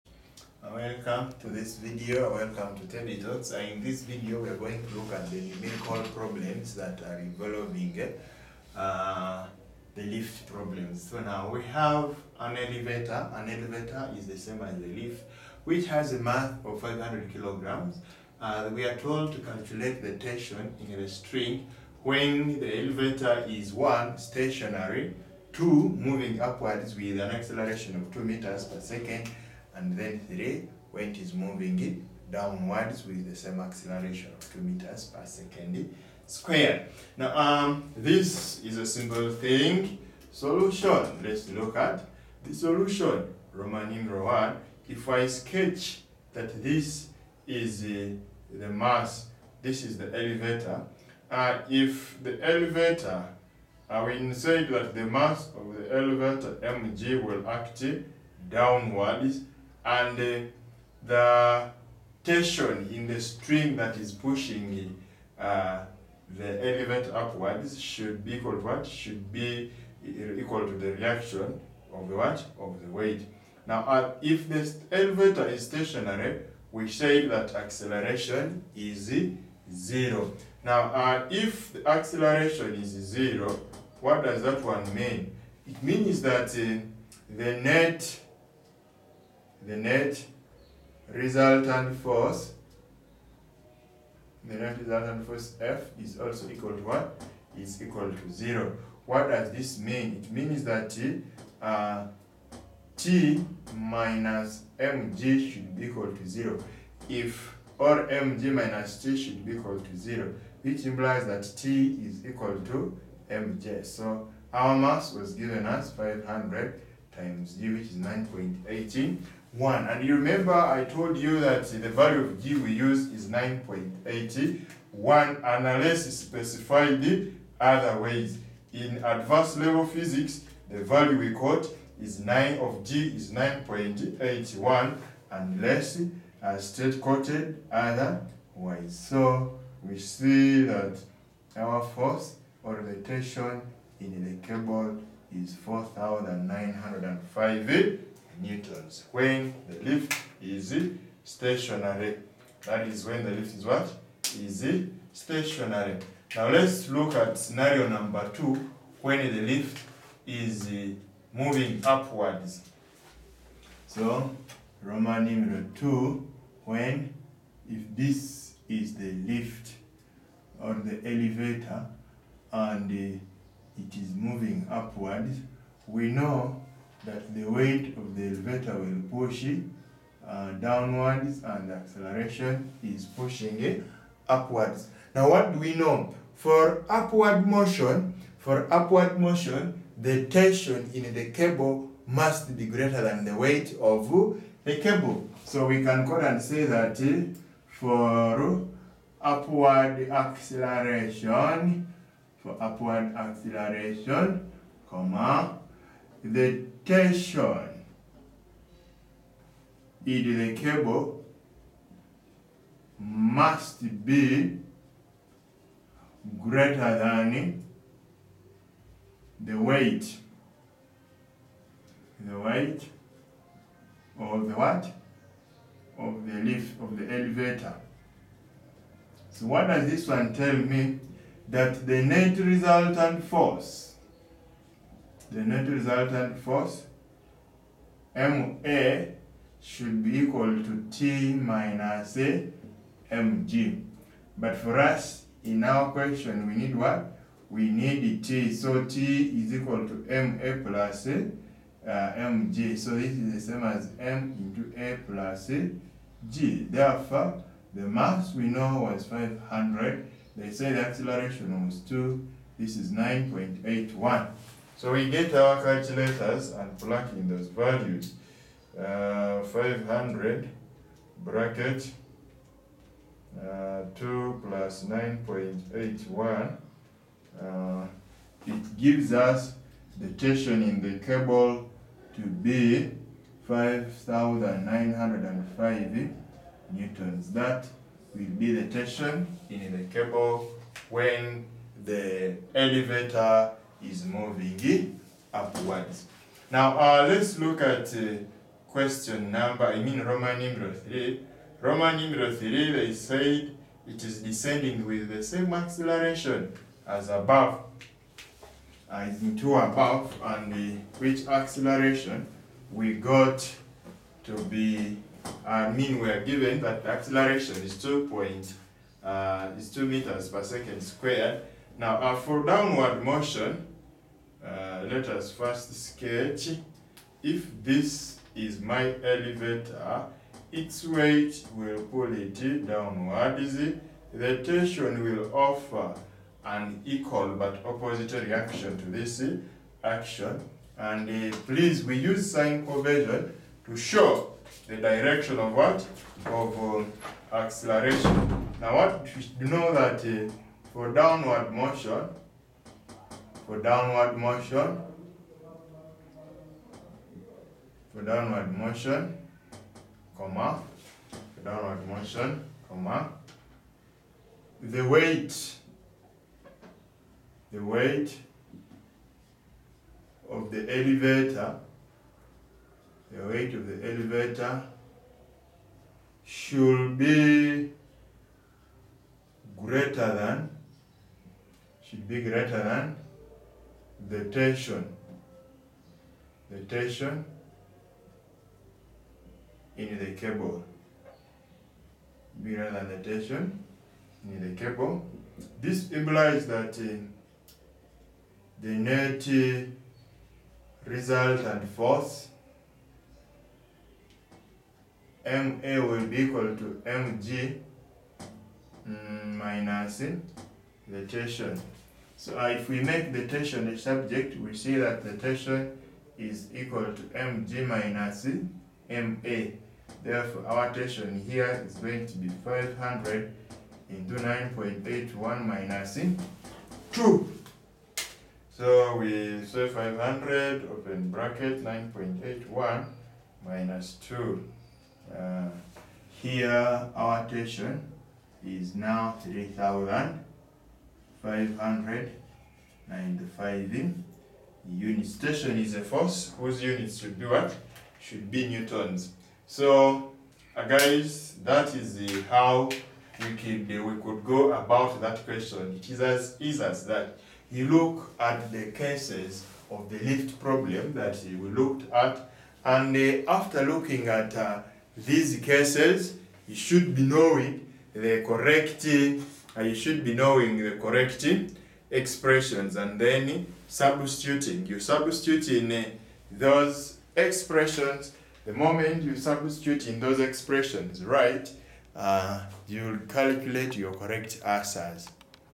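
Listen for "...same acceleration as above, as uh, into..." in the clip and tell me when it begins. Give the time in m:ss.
5:05.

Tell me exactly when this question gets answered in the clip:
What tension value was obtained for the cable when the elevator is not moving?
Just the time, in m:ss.
2:25.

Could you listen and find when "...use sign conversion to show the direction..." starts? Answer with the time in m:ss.
5:41.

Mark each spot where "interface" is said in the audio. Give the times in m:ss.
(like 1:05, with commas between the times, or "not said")
not said.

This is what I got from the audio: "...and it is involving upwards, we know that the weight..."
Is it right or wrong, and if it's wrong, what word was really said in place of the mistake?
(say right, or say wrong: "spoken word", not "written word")
wrong: "moving", not "involving".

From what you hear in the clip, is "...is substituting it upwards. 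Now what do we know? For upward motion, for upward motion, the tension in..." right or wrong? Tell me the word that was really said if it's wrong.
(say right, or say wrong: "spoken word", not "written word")
wrong: "pushing", not "substituting".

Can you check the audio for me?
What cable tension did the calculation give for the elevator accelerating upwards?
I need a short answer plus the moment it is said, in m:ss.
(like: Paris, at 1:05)
5905 newtons, at 4:43.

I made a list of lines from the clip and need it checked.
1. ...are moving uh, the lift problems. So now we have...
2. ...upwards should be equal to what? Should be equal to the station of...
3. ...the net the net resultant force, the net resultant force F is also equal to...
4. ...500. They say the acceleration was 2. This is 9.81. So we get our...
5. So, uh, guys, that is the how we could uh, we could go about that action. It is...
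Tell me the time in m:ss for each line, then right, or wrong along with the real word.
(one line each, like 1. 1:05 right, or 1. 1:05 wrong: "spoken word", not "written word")
1. 0:07 wrong: "involving", not "moving"
2. 1:07 wrong: "reaction", not "station"
3. 1:27 right
4. 4:19 right
5. 7:29 wrong: "question", not "action".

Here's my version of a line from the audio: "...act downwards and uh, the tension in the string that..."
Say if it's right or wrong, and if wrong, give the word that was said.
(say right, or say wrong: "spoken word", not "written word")
right.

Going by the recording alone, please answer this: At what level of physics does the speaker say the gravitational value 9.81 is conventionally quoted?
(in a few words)
advanced level.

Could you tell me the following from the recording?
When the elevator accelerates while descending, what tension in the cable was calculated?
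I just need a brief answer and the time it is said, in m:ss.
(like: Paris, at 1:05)
3,595 newtons, at 7:19.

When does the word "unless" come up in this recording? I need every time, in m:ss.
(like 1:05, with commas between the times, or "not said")
2:05, 2:15.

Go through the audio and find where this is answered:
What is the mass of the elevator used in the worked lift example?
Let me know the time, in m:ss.
0:16.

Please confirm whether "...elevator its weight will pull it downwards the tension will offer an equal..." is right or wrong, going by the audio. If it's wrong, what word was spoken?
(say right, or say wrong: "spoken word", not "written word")
right.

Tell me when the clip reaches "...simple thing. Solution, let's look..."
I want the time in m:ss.
0:38.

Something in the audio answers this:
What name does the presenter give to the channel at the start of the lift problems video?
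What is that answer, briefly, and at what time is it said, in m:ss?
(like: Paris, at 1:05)
Tebtalks, at 0:02.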